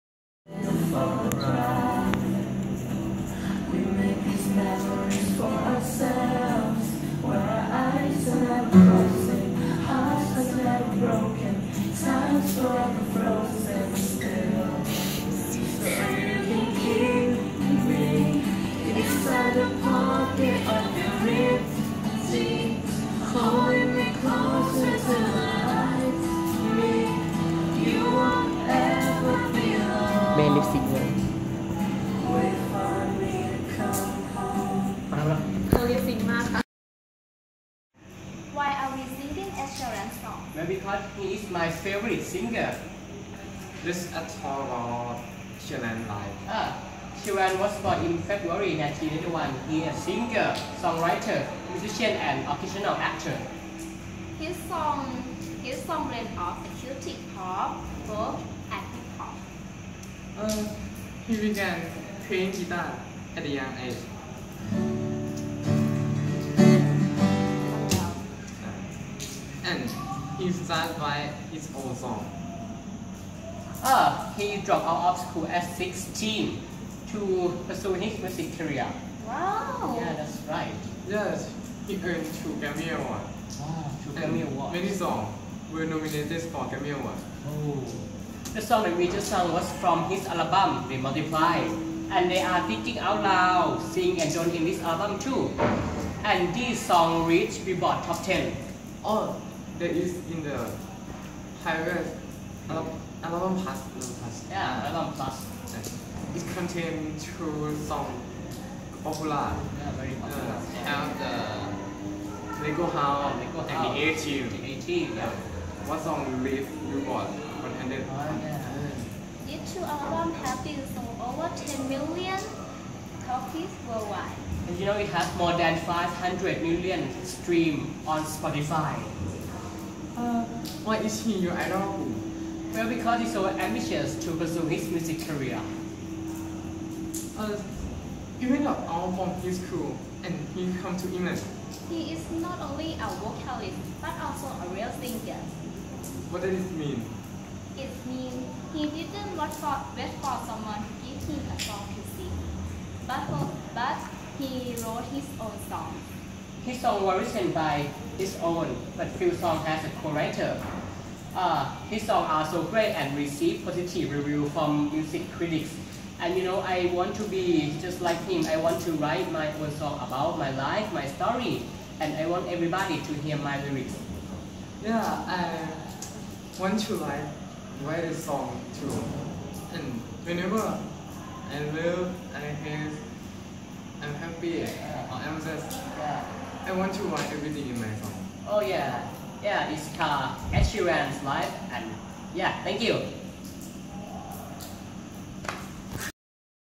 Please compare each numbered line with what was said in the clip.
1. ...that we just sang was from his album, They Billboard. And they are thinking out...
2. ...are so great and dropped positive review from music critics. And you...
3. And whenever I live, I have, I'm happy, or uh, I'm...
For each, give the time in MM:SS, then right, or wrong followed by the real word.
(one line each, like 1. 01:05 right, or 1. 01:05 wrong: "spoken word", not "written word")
1. 01:28 wrong: "Multiply", not "Billboard"
2. 02:42 wrong: "received", not "dropped"
3. 02:59 right.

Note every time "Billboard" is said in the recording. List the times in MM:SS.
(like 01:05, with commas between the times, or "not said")
01:37, 01:56.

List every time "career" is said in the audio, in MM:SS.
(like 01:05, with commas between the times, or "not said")
01:18, 02:15.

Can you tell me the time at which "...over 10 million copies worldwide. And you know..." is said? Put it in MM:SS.
02:01.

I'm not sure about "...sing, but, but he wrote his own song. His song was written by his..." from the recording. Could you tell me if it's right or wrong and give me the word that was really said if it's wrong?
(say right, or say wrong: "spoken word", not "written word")
right.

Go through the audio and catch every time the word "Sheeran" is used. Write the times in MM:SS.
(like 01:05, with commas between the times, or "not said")
00:39, 00:47, 03:10.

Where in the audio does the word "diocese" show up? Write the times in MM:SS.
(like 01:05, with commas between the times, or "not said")
not said.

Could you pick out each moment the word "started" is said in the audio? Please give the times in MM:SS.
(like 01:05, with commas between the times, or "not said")
01:10.